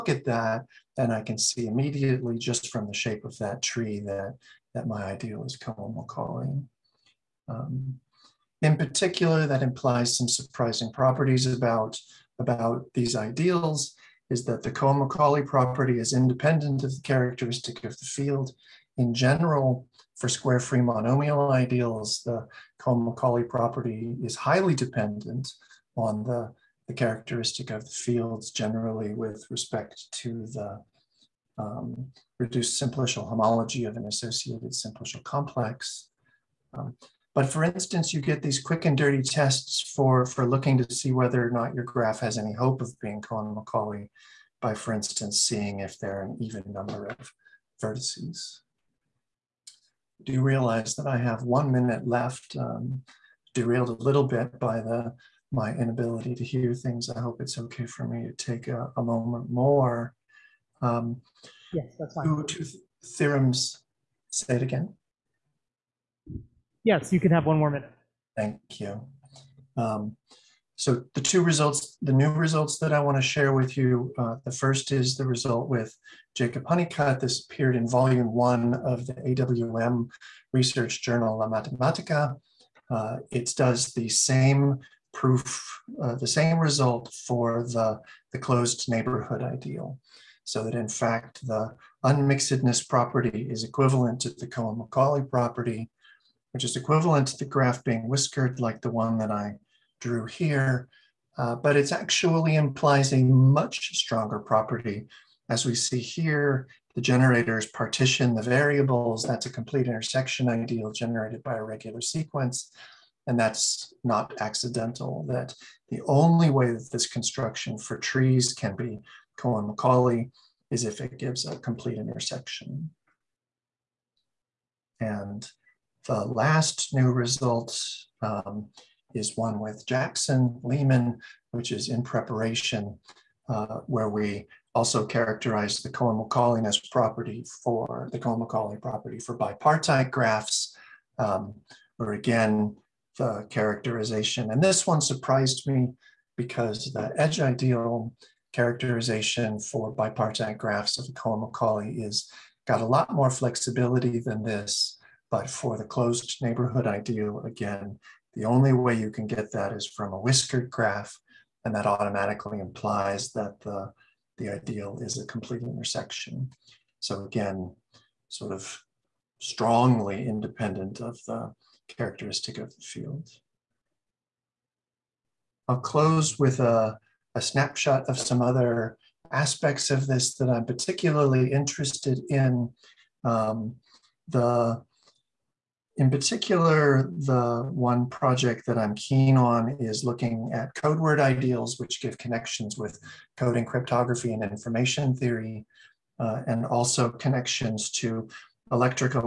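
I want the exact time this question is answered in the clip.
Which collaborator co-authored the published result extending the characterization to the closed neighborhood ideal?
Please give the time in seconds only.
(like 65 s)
76 s.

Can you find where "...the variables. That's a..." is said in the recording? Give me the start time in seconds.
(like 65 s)
108 s.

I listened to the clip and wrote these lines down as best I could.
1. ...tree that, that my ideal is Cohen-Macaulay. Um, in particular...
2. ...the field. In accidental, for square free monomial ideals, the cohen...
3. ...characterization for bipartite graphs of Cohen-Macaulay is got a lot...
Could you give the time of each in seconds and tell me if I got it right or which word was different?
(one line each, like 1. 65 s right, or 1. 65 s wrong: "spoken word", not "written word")
1. 3 s right
2. 17 s wrong: "general", not "accidental"
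3. 148 s right.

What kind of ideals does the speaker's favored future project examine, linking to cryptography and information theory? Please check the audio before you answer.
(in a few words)
code word ideals.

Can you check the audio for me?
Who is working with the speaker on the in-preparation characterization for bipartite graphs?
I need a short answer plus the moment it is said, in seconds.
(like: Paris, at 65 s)
Jackson Lehman, at 129 s.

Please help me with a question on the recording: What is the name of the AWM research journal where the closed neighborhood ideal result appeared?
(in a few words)
La Matematica.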